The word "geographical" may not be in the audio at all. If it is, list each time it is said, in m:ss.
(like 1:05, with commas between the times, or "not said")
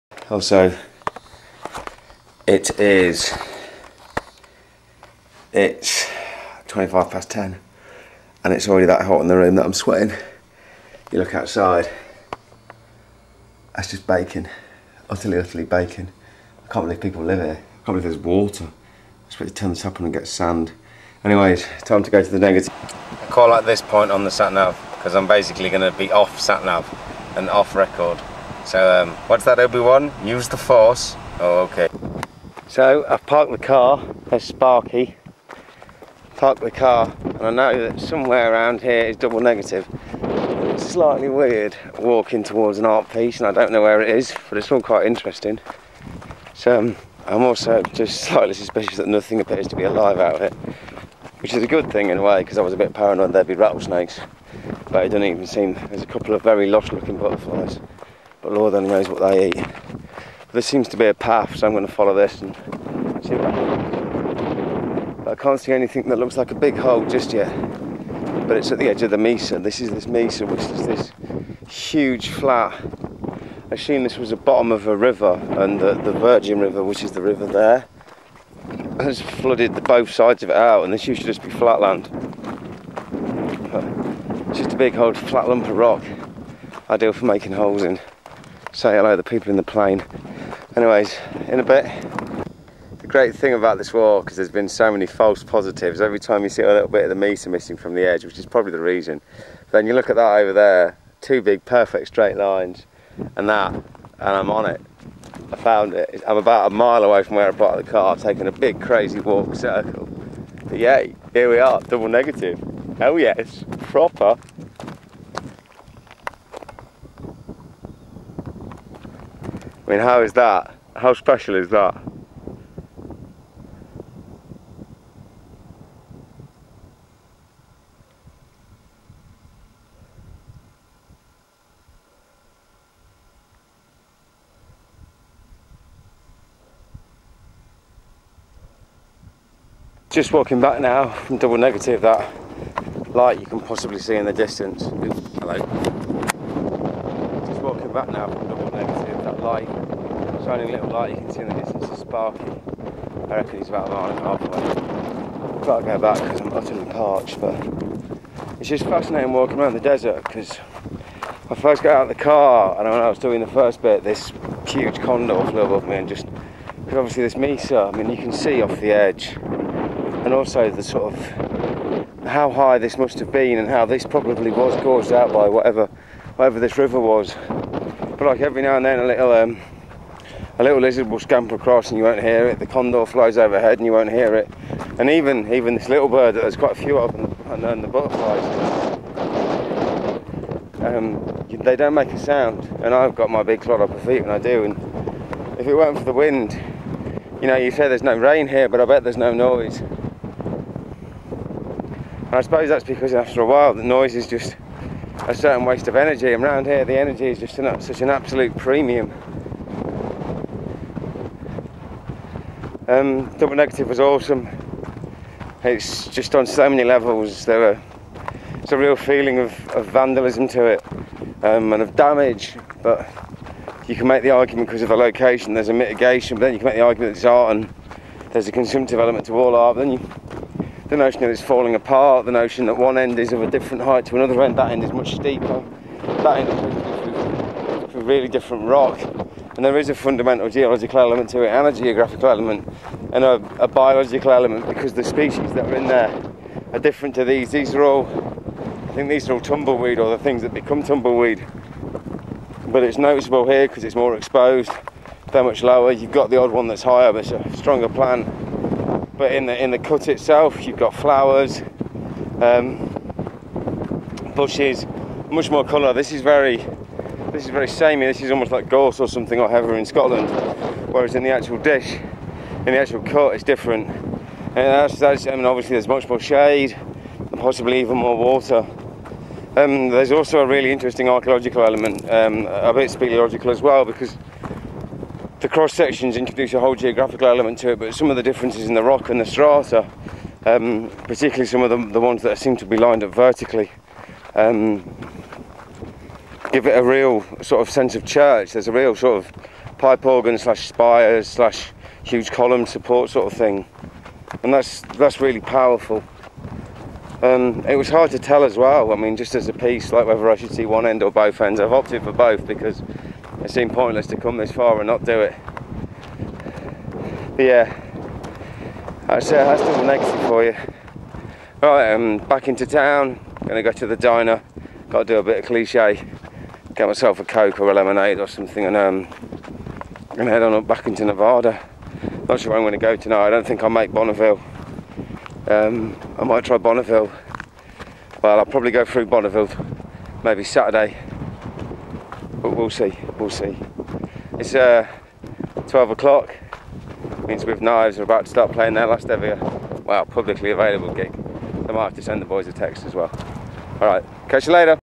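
4:01, 4:46.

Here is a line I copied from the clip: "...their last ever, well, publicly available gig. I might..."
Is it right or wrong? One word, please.
right.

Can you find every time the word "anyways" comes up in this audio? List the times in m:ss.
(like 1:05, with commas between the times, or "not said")
0:21, 1:30.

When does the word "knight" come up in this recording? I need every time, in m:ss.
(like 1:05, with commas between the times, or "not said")
not said.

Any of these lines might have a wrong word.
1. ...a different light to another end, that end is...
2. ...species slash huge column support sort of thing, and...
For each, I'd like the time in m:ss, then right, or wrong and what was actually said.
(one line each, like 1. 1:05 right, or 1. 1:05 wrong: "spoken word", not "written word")
1. 3:53 wrong: "height", not "light"
2. 5:00 wrong: "spires", not "species".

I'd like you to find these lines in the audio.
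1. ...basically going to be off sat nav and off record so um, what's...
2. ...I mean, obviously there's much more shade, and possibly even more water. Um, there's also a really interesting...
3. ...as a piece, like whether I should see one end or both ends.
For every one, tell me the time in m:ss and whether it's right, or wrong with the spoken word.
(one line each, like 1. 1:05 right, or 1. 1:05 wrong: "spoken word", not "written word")
1. 0:25 right
2. 4:35 right
3. 5:09 right.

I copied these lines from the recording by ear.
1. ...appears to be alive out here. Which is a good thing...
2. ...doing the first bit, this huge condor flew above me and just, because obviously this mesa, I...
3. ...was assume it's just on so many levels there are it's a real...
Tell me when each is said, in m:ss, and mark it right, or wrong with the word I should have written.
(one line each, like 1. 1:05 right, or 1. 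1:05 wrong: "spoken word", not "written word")
1. 0:49 right
2. 2:43 right
3. 3:33 wrong: "awesome", not "assume".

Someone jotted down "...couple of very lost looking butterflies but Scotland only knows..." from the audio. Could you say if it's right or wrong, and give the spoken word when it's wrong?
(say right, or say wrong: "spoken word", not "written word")
wrong: "Lord", not "Scotland".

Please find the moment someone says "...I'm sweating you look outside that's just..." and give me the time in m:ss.
0:09.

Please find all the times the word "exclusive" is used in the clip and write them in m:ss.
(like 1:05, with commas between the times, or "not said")
not said.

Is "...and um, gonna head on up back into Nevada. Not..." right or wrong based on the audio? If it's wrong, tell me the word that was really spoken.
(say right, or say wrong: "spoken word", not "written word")
right.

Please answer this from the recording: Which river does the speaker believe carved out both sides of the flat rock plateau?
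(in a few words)
Virgin River.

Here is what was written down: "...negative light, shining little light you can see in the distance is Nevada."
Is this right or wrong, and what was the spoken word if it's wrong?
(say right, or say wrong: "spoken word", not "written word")
wrong: "Sparky", not "Nevada".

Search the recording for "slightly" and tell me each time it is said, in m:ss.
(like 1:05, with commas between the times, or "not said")
0:40, 0:48.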